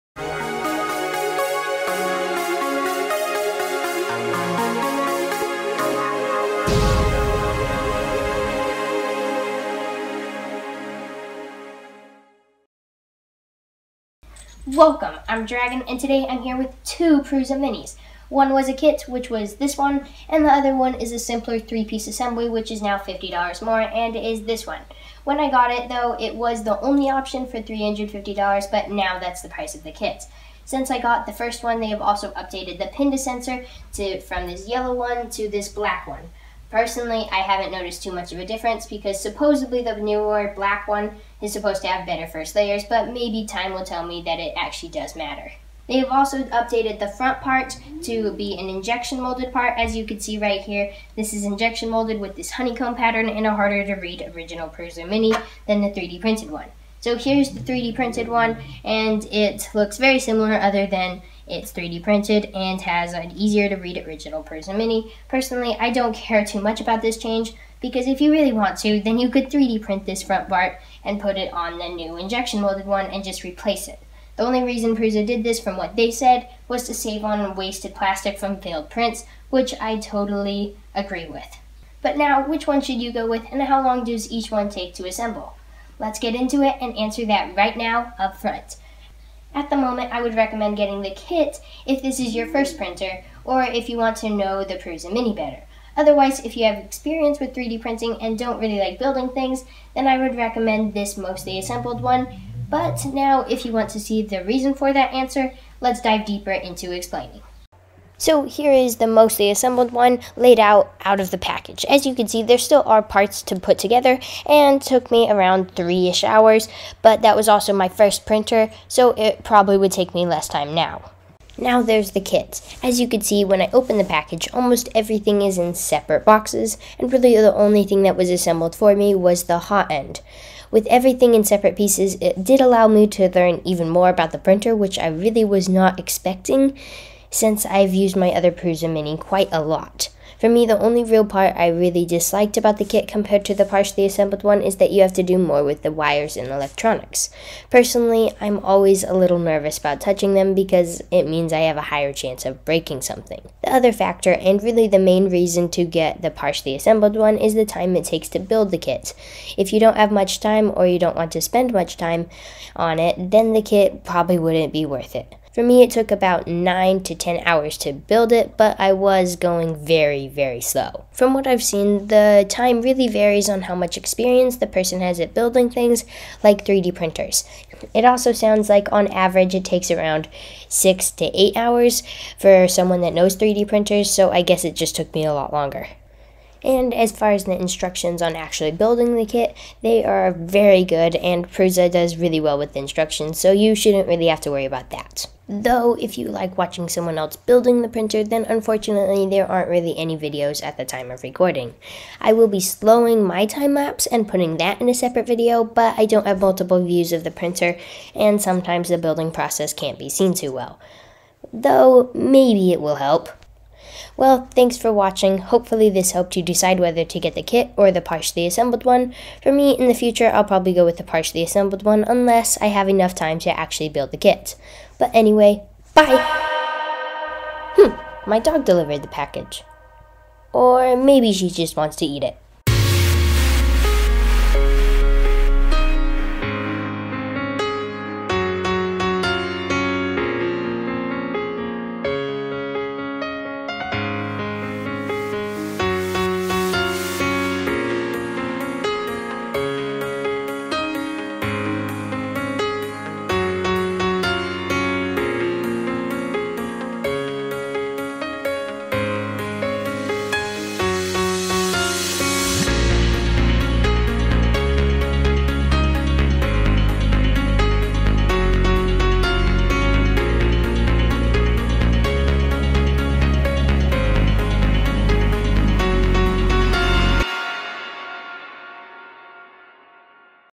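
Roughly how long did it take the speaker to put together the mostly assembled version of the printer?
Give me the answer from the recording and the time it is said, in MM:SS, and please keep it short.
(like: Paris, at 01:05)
3 hours, at 01:55.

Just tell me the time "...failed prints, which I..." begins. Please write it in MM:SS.
01:18.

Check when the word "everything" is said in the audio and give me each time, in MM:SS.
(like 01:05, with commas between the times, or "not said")
02:04, 02:10.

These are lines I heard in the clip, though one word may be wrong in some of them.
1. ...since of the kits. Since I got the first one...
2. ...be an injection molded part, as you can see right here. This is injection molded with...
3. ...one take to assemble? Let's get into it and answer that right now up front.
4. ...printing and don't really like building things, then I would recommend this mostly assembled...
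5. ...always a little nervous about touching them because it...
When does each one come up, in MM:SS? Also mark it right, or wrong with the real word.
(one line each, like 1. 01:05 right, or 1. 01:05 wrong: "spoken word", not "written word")
1. 00:29 wrong: "price", not "since"
2. 00:48 right
3. 01:24 right
4. 01:37 right
5. 02:28 right.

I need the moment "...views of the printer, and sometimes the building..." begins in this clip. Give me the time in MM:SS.
03:26.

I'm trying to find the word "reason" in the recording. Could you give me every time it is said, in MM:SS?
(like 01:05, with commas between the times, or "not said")
01:14, 01:44, 02:35.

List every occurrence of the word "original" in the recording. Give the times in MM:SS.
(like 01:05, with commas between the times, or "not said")
00:54, 01:04.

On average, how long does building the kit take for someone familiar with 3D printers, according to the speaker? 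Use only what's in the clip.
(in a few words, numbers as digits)
6 to 8 hours.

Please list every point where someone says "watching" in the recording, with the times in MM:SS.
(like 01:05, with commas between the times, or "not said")
03:16, 03:34.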